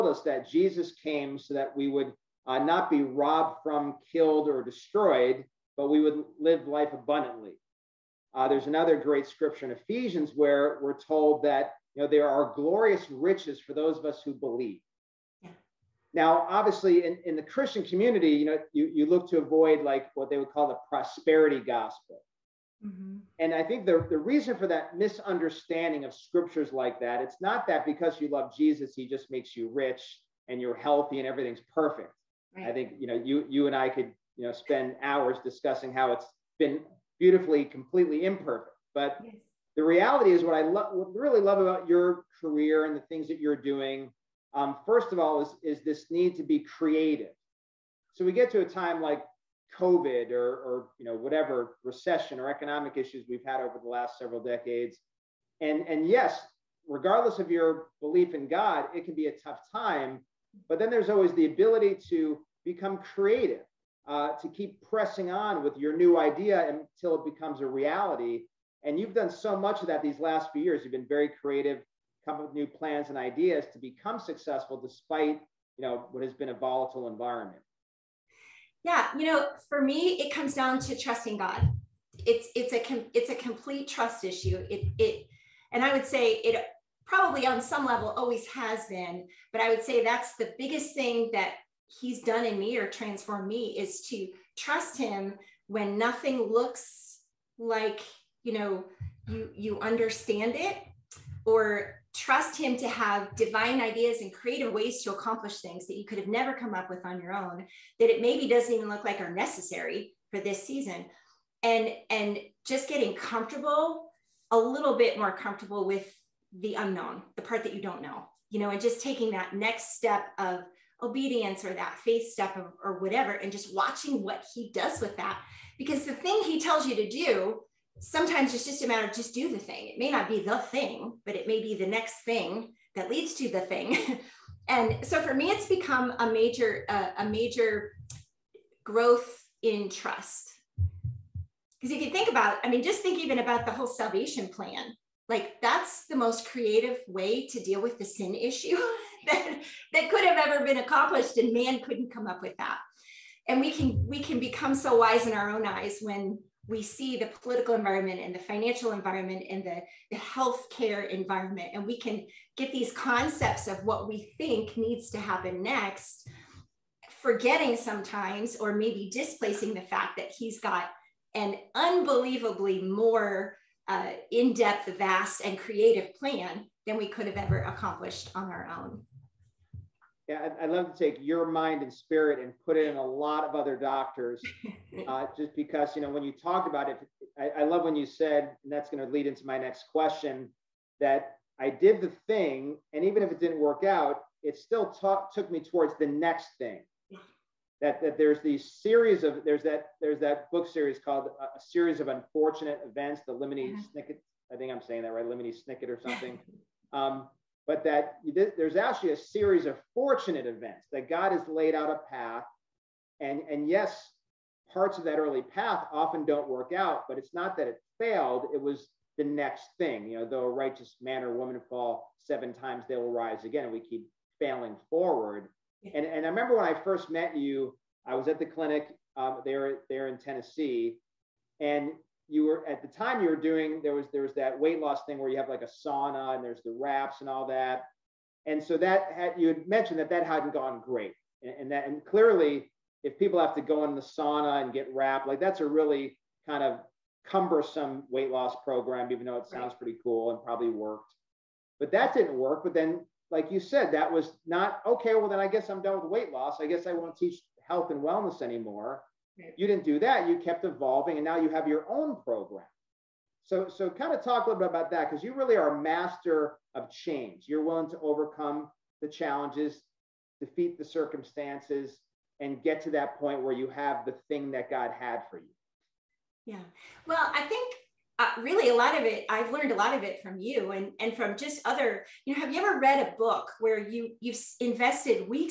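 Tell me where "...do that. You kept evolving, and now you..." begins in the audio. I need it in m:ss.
4:19.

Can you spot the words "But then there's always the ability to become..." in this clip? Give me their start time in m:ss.
1:00.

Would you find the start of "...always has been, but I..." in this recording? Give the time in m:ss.
1:28.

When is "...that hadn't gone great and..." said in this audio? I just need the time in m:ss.
4:00.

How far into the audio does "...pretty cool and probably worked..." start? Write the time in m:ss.
4:09.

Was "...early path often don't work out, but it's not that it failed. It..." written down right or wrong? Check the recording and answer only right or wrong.
right.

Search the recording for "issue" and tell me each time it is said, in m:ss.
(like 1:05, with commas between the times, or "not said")
0:52, 1:24, 2:28.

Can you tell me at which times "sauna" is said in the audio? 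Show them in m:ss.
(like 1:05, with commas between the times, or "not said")
3:55, 4:04.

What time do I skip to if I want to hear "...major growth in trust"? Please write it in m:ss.
2:17.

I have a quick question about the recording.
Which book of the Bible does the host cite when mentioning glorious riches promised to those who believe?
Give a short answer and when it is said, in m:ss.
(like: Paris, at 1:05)
Ephesians, at 0:09.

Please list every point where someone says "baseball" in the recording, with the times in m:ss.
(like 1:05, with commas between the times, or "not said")
not said.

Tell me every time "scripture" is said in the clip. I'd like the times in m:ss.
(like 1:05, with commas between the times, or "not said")
0:09, 0:26.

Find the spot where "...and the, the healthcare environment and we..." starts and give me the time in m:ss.
2:39.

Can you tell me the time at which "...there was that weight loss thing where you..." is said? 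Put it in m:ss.
3:54.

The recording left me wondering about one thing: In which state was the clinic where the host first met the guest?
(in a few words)
Tennessee.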